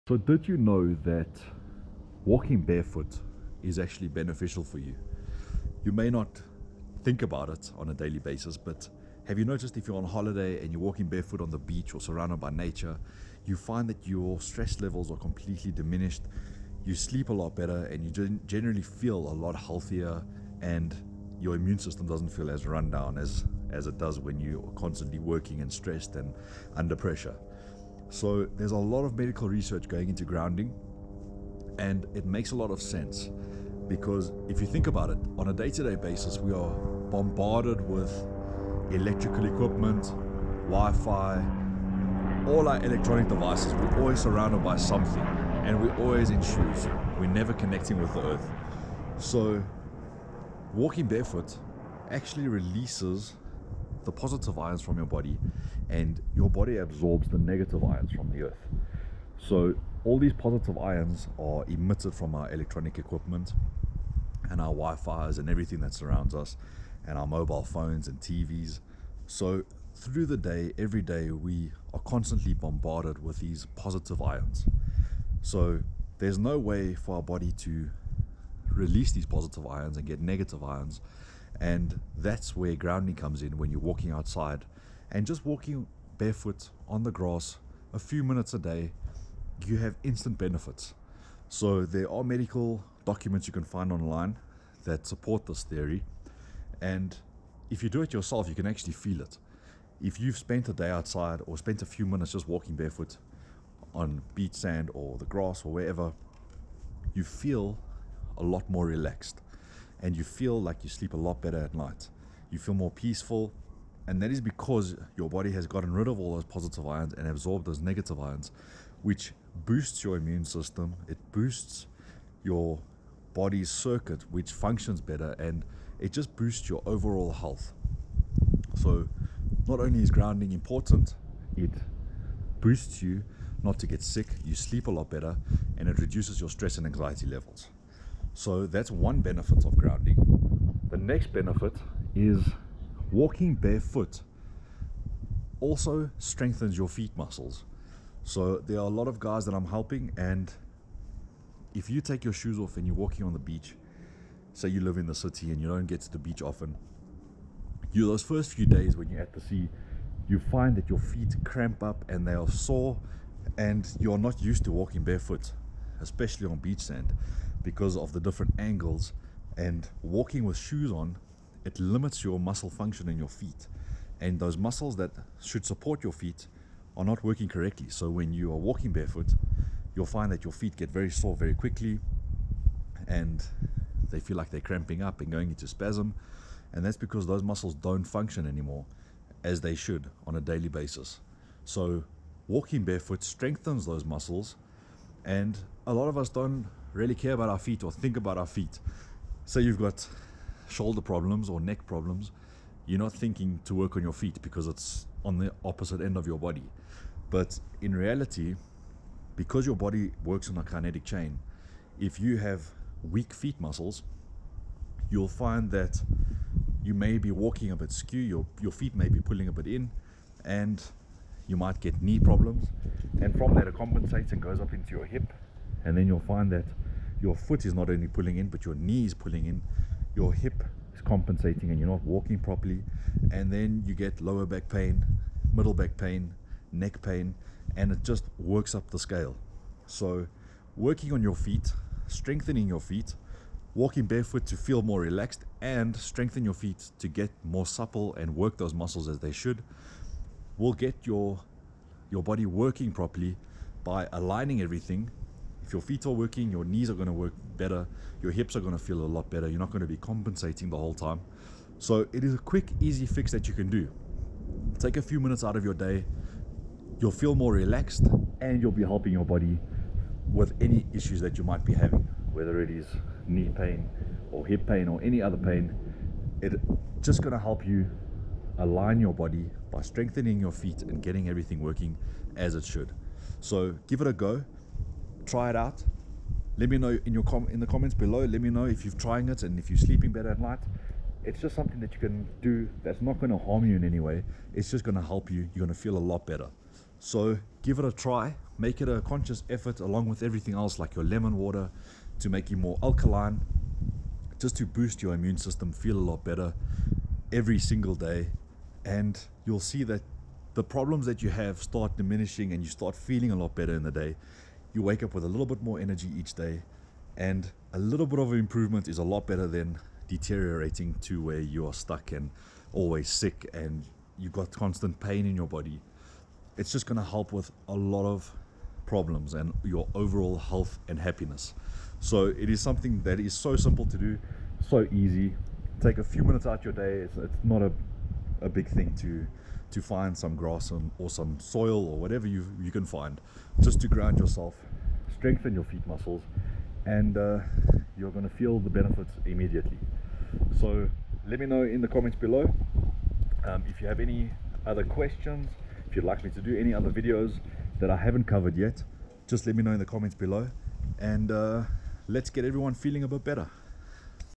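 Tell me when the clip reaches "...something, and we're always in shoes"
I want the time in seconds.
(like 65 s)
44 s.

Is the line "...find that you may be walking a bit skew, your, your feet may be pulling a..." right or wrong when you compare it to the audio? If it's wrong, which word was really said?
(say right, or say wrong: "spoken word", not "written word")
right.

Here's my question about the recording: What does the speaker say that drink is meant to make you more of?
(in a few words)
alkaline.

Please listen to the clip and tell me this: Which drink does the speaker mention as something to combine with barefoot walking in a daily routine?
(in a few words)
lemon water.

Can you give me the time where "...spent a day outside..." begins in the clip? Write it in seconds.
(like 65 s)
100 s.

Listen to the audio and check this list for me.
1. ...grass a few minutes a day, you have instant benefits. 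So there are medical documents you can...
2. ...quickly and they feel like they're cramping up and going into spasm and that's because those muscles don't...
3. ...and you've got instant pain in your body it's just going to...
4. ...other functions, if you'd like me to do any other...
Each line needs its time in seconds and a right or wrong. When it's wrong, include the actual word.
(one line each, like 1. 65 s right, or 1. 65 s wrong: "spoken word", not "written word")
1. 87 s right
2. 181 s right
3. 323 s wrong: "constant", not "instant"
4. 354 s wrong: "questions", not "functions".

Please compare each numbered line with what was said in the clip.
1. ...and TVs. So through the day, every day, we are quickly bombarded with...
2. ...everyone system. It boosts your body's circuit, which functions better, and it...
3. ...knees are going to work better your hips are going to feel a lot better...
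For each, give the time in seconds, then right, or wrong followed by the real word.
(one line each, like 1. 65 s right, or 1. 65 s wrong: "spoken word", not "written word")
1. 68 s wrong: "constantly", not "quickly"
2. 120 s wrong: "immune", not "everyone"
3. 256 s right.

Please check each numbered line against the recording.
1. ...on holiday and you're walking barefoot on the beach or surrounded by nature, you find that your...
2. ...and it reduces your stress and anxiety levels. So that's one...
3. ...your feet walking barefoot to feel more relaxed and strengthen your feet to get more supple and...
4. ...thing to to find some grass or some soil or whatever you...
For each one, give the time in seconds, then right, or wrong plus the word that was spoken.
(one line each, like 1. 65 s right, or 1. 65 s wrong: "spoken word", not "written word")
1. 9 s right
2. 135 s right
3. 242 s right
4. 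338 s right.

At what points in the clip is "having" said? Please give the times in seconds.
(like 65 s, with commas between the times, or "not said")
271 s.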